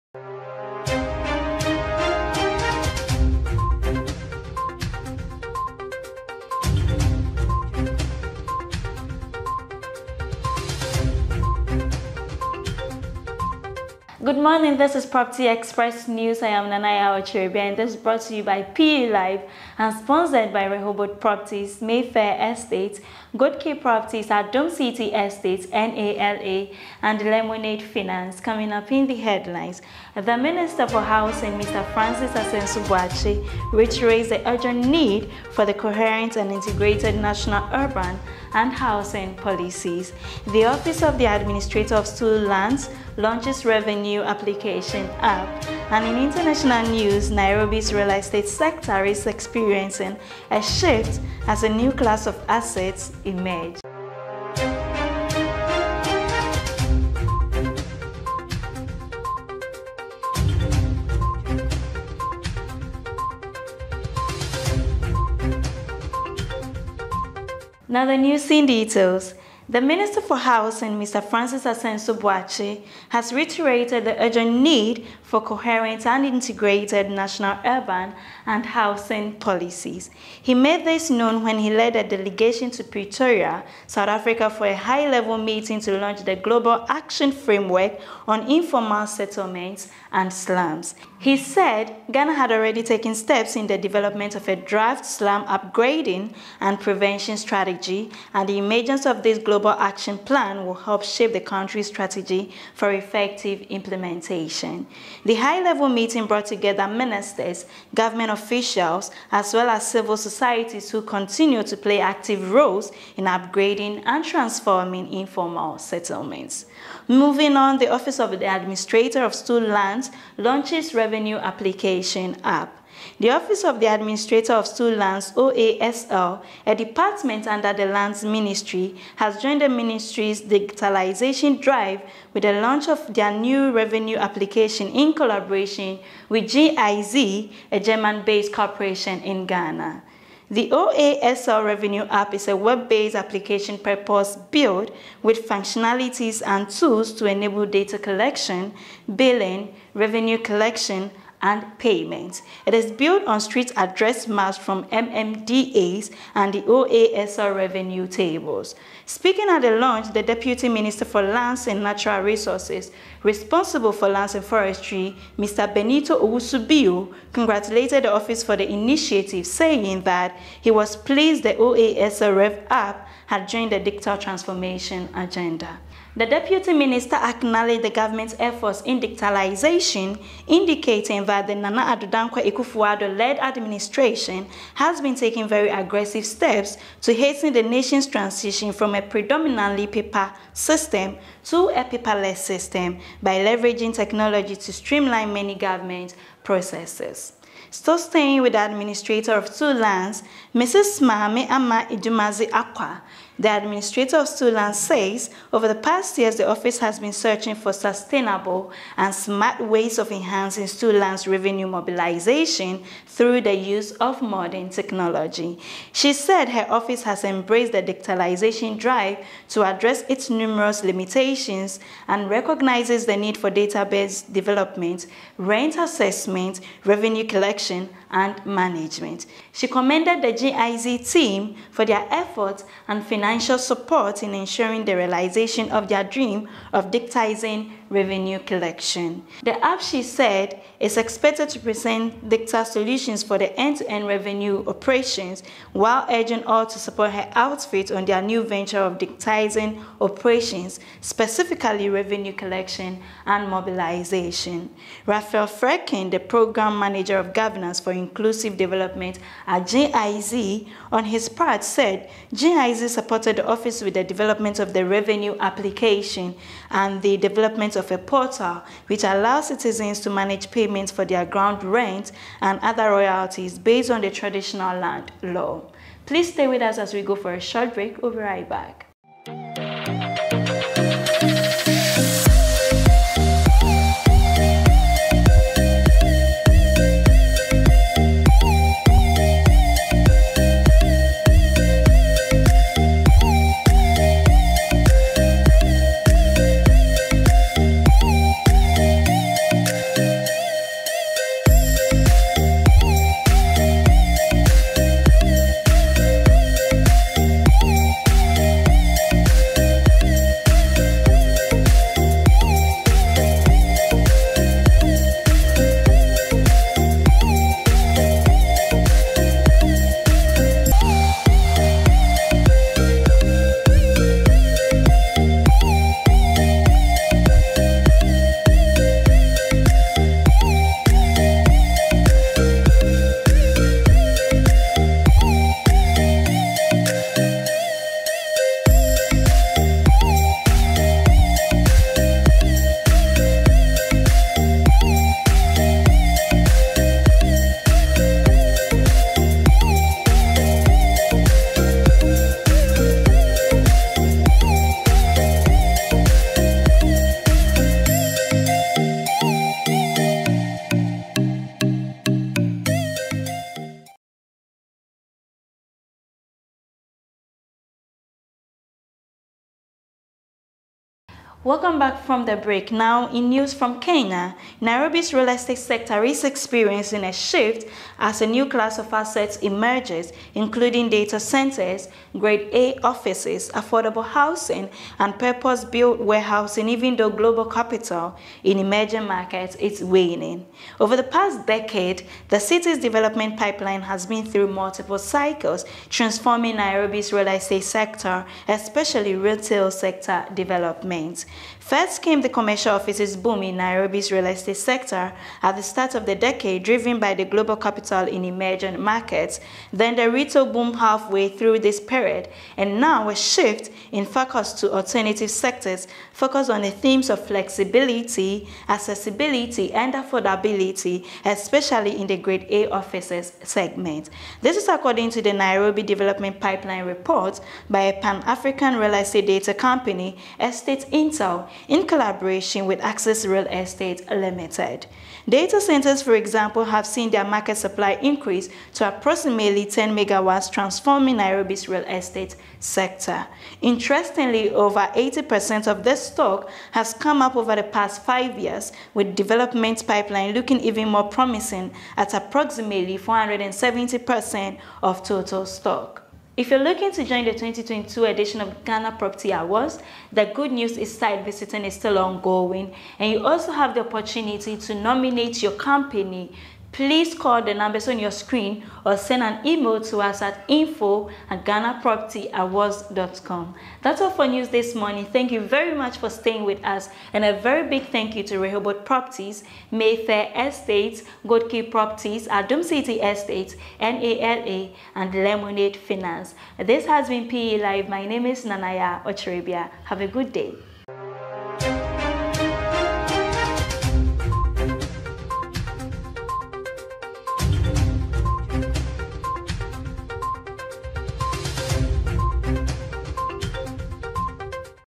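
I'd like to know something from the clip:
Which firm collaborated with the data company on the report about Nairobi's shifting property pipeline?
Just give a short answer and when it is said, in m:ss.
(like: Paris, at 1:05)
Access Real Estate Limited, at 7:12.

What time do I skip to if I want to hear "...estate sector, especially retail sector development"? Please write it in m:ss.
6:37.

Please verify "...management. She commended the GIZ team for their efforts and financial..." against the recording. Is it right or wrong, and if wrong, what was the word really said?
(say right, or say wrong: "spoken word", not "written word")
right.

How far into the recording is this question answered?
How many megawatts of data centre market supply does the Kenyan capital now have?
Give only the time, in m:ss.
7:19.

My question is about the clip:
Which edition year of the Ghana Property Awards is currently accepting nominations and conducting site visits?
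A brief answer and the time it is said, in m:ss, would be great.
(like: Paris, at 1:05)
2022, at 7:37.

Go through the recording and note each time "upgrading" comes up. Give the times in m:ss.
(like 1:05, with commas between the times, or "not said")
1:35, 1:53.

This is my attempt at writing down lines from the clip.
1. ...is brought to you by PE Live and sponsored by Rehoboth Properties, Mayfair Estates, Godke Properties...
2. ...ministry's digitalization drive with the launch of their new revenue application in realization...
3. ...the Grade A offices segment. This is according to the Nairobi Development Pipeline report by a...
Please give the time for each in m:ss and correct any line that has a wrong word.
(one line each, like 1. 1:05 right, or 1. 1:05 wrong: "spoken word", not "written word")
1. 0:17 right
2. 2:09 wrong: "collaboration", not "realization"
3. 7:02 right.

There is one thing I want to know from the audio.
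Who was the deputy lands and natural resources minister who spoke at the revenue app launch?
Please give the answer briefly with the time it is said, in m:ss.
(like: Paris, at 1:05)
Benito Owusu-Bio, at 2:45.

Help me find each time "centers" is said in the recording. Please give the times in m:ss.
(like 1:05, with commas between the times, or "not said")
6:21, 7:15.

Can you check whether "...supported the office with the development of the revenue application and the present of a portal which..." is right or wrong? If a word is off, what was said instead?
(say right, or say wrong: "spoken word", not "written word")
wrong: "development", not "present".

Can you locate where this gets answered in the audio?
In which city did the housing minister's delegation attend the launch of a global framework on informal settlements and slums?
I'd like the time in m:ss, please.
1:22.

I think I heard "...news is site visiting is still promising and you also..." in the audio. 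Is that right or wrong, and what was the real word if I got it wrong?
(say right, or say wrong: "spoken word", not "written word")
wrong: "ongoing", not "promising".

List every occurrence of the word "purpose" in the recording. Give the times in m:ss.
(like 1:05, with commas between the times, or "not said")
2:23, 6:25.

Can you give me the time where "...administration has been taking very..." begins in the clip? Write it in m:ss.
3:03.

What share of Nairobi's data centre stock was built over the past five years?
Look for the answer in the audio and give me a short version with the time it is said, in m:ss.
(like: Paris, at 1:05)
over 80%, at 7:24.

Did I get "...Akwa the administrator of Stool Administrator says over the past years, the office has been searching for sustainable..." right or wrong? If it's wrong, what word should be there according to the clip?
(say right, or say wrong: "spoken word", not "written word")
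wrong: "Land", not "Administrator".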